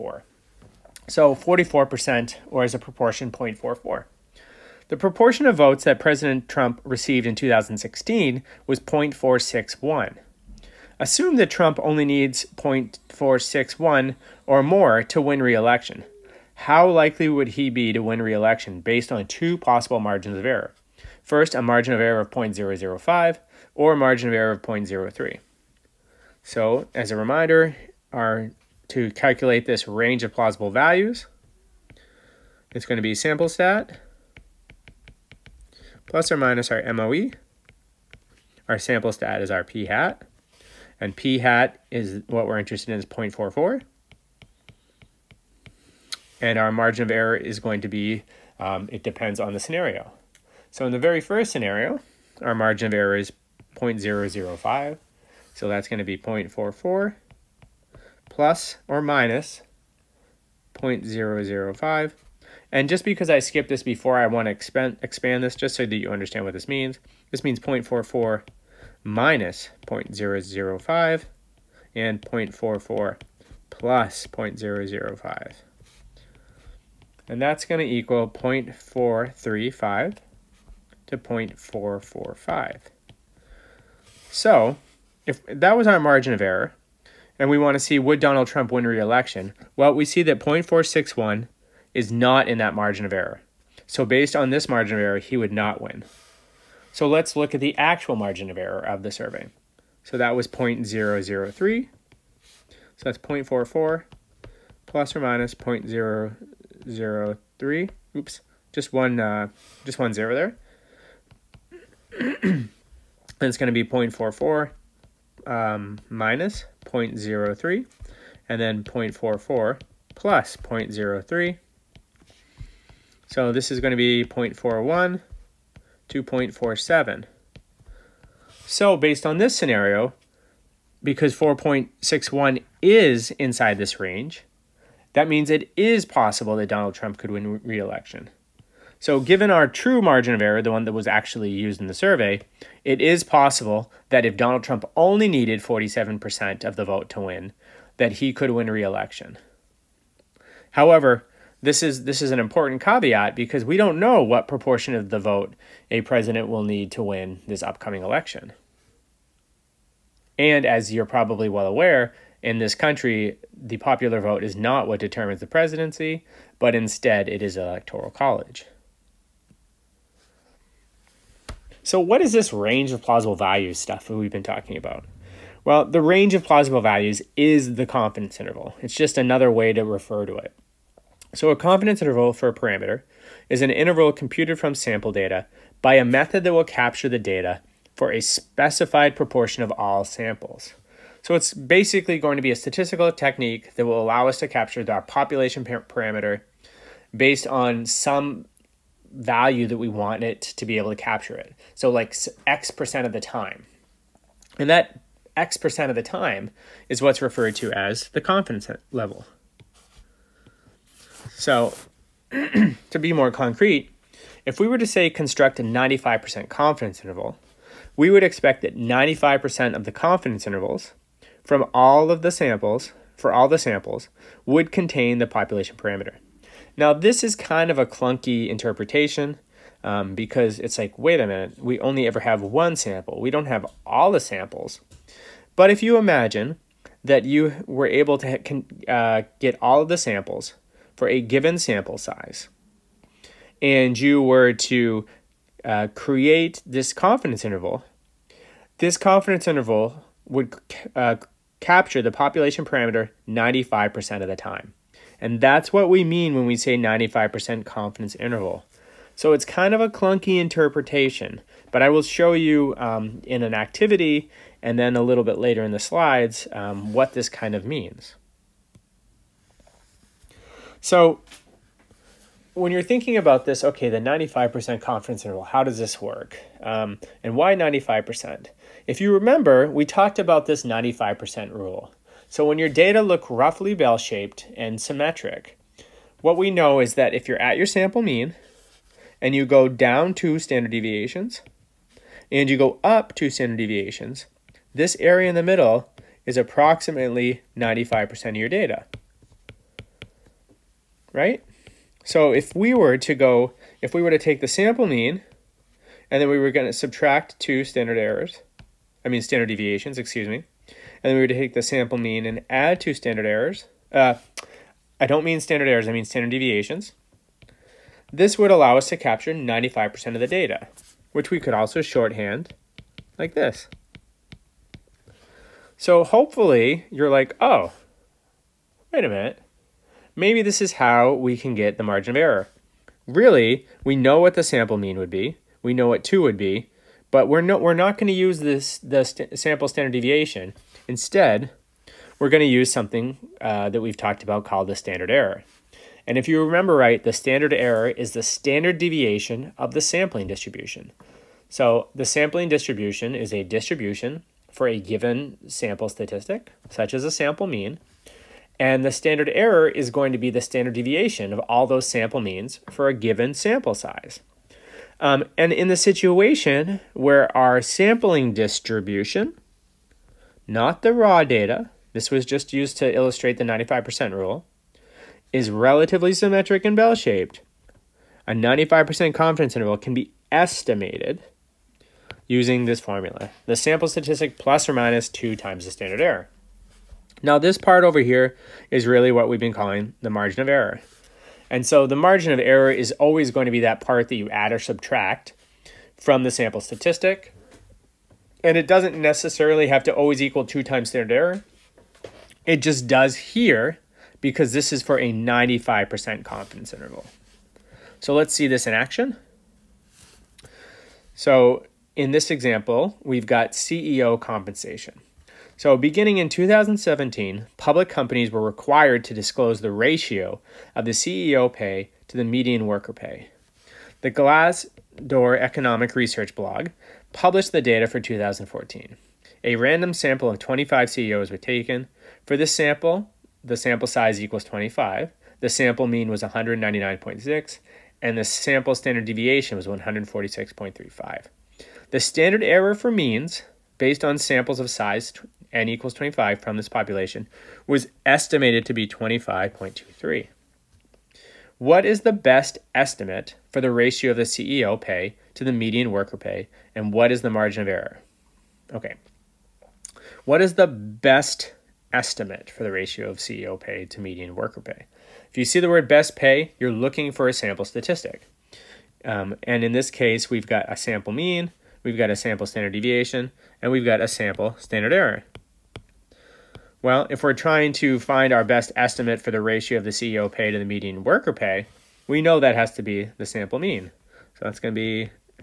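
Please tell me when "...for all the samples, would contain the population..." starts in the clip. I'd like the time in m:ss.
3:43.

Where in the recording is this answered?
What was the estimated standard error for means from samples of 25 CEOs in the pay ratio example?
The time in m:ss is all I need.
7:28.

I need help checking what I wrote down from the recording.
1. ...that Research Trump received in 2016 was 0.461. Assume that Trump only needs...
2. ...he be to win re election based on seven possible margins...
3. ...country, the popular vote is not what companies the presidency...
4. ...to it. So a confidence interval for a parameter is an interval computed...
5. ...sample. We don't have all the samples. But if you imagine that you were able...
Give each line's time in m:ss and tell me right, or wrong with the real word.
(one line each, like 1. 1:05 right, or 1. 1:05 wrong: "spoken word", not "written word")
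1. 0:05 wrong: "President", not "Research"
2. 0:17 wrong: "two", not "seven"
3. 2:42 wrong: "determines", not "companies"
4. 3:00 right
5. 3:52 right.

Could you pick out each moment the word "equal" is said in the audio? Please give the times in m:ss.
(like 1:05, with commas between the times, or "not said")
1:17, 6:40, 7:14, 7:25.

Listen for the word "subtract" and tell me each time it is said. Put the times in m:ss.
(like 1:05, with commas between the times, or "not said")
5:06, 6:34.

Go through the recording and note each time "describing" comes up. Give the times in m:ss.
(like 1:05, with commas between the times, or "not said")
not said.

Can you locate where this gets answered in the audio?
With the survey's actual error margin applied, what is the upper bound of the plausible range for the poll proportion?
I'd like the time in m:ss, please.
2:04.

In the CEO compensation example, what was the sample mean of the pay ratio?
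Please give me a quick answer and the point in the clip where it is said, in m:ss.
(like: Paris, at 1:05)
199.6, at 7:16.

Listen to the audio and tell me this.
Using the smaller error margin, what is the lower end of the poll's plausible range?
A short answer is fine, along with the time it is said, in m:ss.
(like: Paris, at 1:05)
0.435, at 1:18.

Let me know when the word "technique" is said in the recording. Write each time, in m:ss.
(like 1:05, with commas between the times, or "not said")
3:13.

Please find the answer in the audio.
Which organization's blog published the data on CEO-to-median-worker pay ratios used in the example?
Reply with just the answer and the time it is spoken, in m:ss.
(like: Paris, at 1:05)
Glassdoor Economic Research, at 7:04.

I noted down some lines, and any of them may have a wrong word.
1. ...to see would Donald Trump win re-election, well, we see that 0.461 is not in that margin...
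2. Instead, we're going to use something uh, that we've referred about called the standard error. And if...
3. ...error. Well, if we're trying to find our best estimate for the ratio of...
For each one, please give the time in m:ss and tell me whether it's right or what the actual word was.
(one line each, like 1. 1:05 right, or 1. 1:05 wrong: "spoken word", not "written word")
1. 1:27 right
2. 5:40 wrong: "talked", not "referred"
3. 7:54 right.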